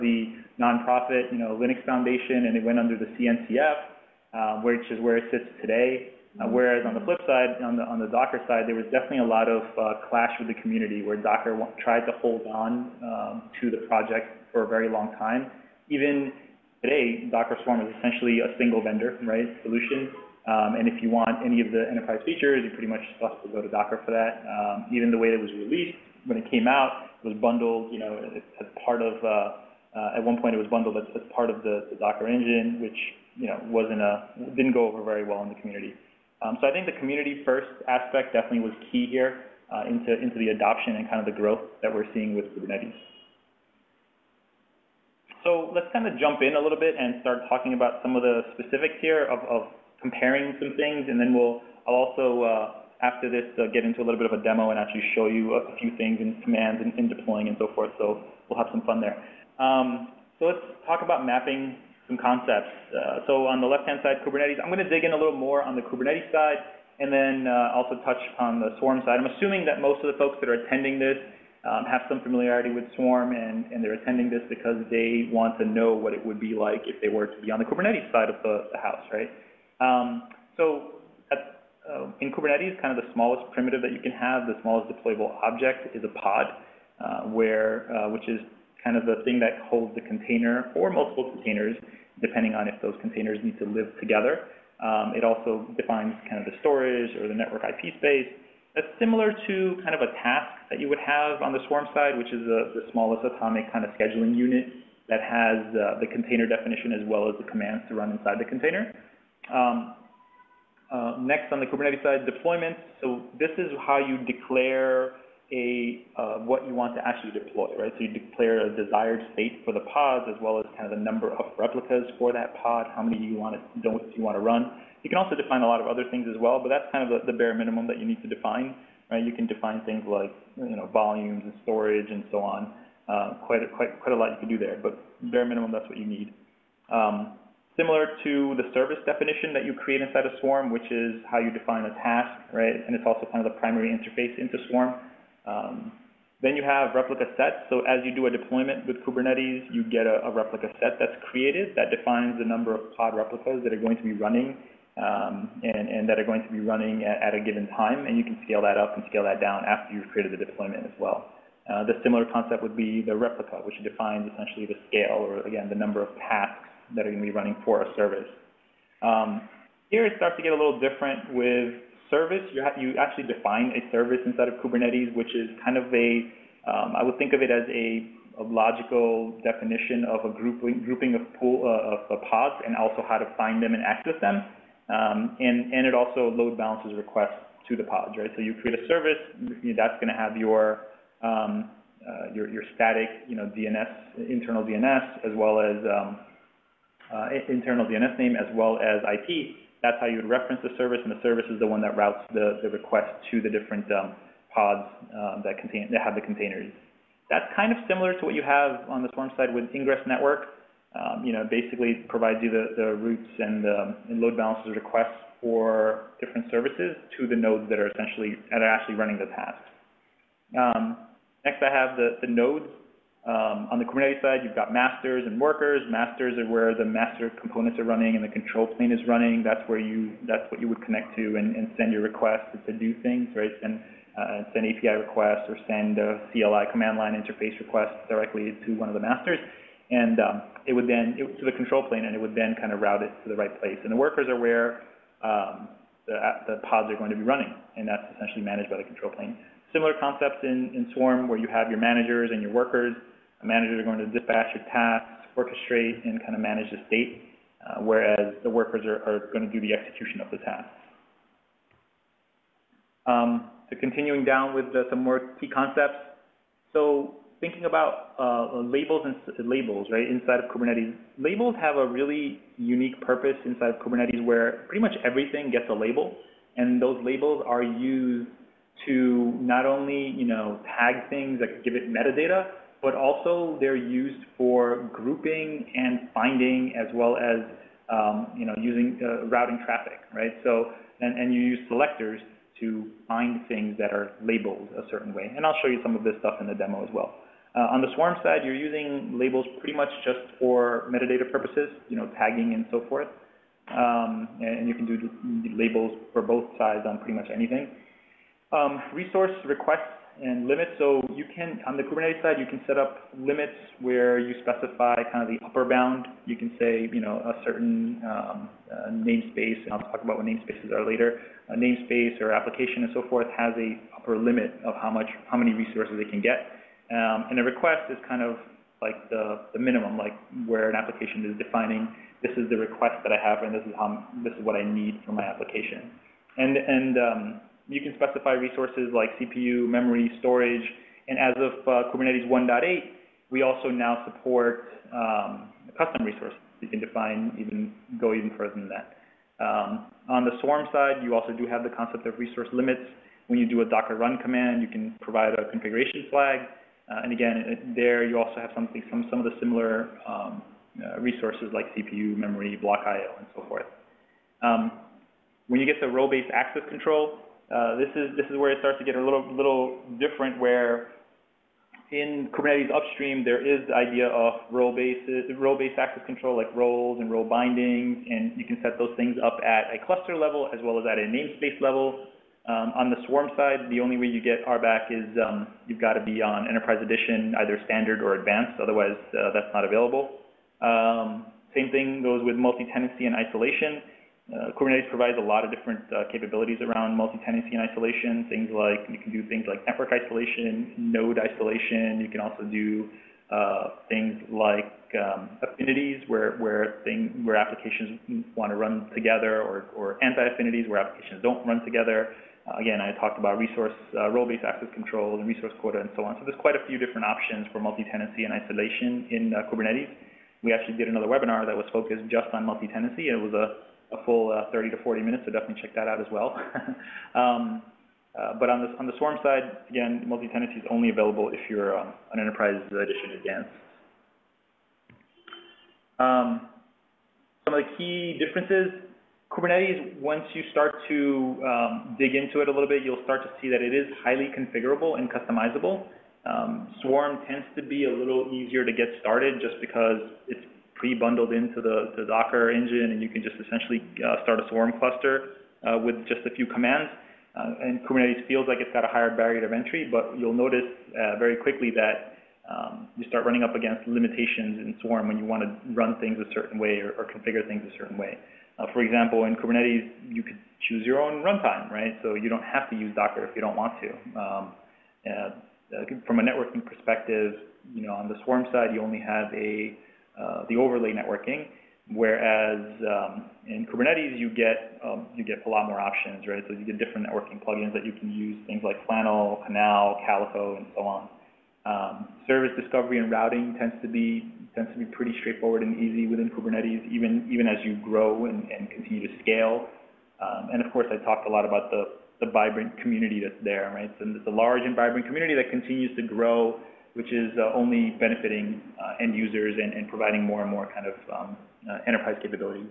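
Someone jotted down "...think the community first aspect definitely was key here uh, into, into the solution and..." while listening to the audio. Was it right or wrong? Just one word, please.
wrong.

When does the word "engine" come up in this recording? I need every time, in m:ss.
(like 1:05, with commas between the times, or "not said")
0:32, 7:32.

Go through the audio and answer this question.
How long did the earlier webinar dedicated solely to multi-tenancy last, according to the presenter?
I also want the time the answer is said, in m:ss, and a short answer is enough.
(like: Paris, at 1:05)
30 to 40 minutes, at 7:04.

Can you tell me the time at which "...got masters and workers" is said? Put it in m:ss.
3:44.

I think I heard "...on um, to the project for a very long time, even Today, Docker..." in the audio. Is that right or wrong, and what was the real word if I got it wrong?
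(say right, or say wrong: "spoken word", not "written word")
right.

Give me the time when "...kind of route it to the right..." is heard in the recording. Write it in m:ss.
4:02.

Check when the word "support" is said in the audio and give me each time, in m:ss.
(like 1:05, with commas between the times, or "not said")
5:44.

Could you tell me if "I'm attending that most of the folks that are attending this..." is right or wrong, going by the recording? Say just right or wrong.
wrong.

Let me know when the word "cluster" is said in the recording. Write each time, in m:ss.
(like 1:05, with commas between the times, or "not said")
6:19, 7:34.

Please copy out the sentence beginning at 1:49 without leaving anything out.
Um, uh, next on the Kubernetes side, deployments.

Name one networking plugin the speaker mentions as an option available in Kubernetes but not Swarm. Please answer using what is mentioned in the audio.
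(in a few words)
Flannel.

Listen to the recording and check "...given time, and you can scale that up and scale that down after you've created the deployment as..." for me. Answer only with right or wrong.
right.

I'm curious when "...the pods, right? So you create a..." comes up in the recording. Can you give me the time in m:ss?
3:07.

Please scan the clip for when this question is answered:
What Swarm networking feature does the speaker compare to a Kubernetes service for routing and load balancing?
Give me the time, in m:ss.
3:29.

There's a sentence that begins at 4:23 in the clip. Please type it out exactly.
Um, so continuing down with the, some more key concepts.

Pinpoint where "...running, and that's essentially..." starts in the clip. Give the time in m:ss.
4:07.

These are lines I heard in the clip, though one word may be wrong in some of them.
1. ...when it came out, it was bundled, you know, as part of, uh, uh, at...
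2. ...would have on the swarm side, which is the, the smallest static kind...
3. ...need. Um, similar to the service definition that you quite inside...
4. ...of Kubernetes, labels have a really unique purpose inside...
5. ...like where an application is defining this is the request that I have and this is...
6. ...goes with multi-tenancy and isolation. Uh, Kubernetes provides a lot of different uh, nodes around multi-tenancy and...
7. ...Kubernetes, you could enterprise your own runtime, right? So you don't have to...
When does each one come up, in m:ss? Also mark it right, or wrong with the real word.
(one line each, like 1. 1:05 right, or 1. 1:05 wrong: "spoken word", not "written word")
1. 0:26 right
2. 1:40 wrong: "atomic", not "static"
3. 2:16 wrong: "create", not "quite"
4. 4:30 right
5. 5:29 right
6. 6:32 wrong: "capabilities", not "nodes"
7. 7:49 wrong: "choose", not "enterprise".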